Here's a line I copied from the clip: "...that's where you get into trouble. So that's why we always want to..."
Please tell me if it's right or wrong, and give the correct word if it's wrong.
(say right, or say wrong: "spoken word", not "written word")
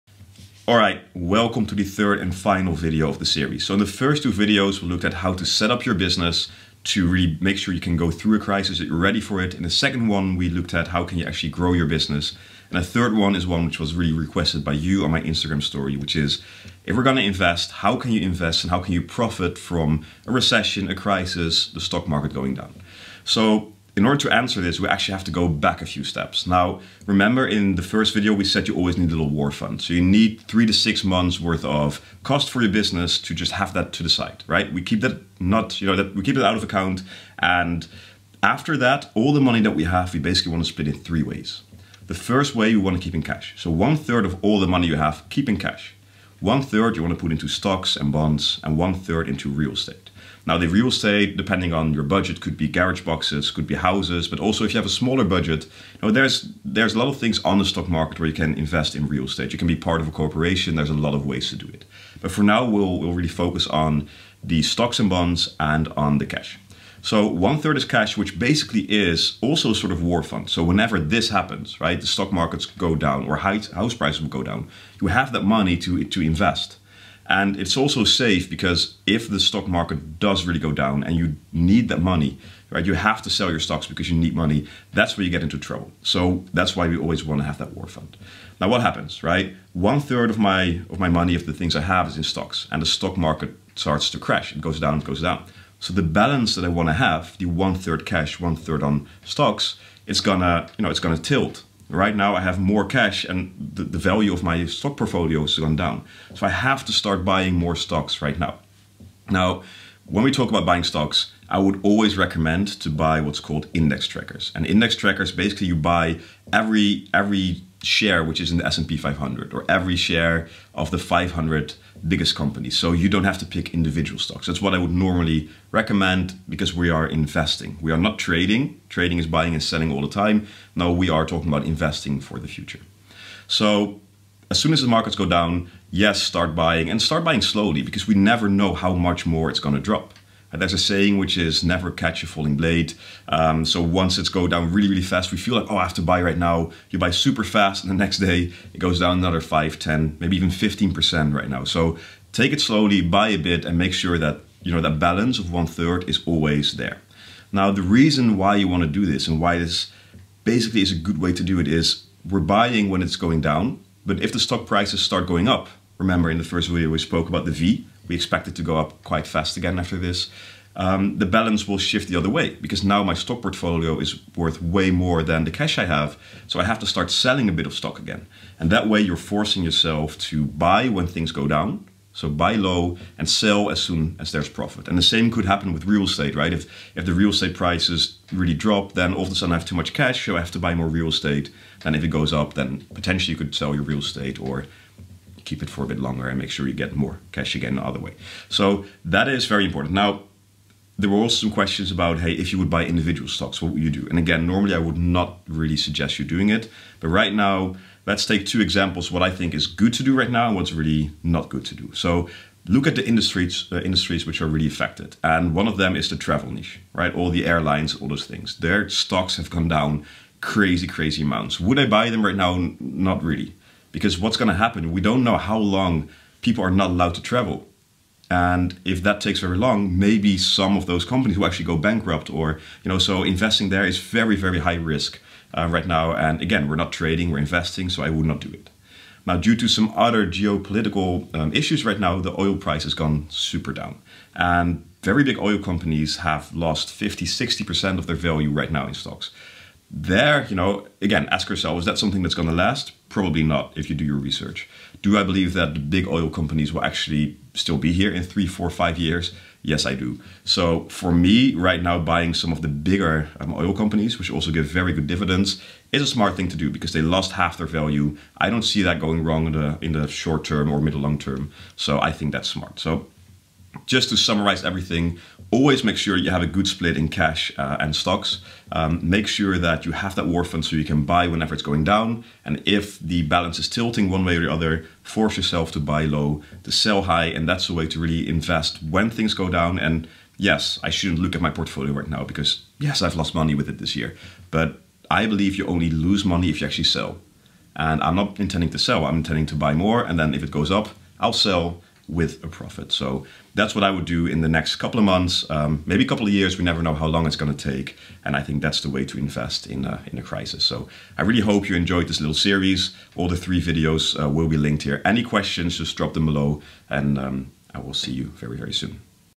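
right.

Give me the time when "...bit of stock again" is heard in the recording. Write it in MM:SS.
02:57.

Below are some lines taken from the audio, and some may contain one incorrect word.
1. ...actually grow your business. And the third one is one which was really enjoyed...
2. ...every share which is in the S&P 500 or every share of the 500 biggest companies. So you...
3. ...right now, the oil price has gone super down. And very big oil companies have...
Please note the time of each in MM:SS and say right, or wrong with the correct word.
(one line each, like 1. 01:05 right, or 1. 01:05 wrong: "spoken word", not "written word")
1. 00:11 wrong: "requested", not "enjoyed"
2. 01:57 right
3. 04:01 right.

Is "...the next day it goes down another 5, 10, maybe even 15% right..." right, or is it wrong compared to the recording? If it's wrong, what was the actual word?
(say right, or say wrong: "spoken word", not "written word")
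right.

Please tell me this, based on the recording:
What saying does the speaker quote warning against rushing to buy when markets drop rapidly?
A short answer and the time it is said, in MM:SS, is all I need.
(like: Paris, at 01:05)
Never catch a falling blade, at 02:21.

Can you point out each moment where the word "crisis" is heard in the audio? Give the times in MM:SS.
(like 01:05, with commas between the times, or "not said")
00:08, 00:20, 05:10.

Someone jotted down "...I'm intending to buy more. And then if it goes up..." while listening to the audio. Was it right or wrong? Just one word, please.
right.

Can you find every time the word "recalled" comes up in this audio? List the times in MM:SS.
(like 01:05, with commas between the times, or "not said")
not said.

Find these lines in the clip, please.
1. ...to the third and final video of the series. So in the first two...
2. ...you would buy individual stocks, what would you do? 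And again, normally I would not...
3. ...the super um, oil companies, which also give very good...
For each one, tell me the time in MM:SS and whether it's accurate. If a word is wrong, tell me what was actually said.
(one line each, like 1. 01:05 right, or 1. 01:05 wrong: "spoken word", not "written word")
1. 00:01 right
2. 03:22 right
3. 04:22 wrong: "bigger", not "super".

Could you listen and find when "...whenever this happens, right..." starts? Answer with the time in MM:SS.
01:10.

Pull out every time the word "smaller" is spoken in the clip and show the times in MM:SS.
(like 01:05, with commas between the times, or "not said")
00:54.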